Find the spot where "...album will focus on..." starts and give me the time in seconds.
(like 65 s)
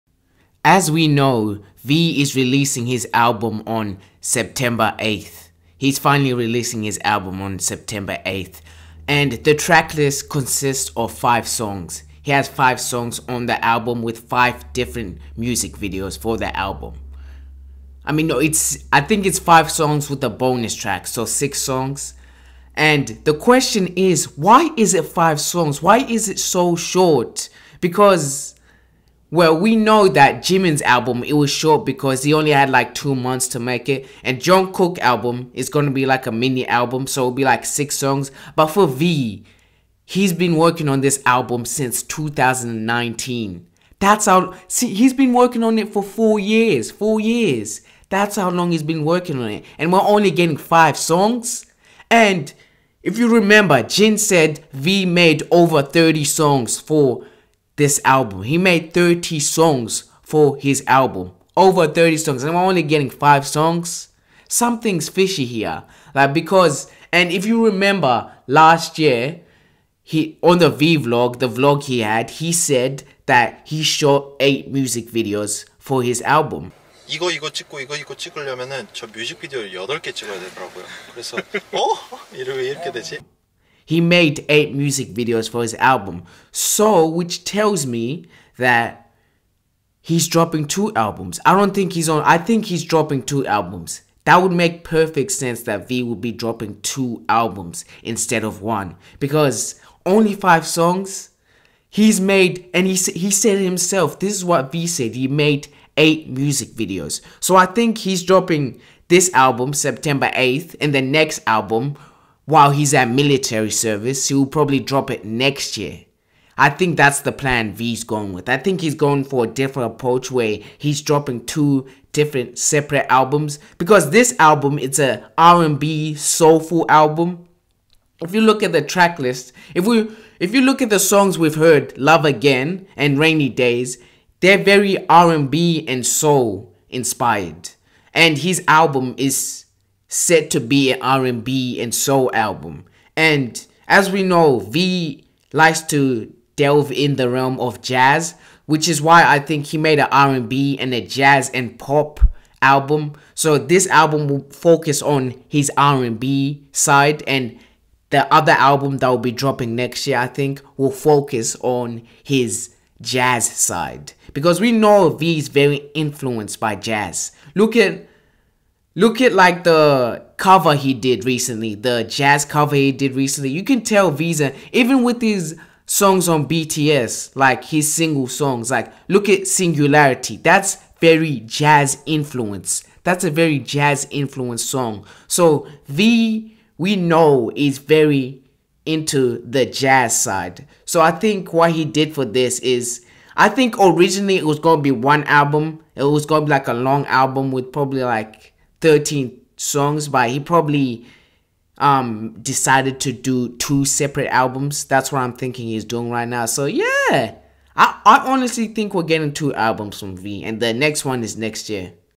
153 s.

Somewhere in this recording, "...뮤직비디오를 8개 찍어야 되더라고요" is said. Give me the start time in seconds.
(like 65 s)
79 s.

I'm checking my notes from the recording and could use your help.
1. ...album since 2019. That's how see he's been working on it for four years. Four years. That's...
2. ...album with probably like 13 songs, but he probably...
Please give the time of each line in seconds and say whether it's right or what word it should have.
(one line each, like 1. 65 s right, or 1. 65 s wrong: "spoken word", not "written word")
1. 41 s right
2. 197 s right.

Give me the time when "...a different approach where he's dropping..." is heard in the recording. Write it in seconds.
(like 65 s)
119 s.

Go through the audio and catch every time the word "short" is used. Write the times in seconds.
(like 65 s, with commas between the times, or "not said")
26 s, 31 s.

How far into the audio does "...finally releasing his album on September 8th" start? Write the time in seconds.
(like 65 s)
5 s.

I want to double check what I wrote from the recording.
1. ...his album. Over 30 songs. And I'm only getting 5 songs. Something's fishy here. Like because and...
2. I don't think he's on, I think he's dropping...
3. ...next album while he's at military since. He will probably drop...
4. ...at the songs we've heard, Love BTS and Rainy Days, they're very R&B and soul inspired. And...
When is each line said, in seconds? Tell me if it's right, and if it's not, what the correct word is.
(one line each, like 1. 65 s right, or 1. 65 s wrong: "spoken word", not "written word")
1. 60 s right
2. 91 s right
3. 111 s wrong: "service", not "since"
4. 130 s wrong: "Again", not "BTS".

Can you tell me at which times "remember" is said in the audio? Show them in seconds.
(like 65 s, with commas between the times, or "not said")
53 s, 67 s.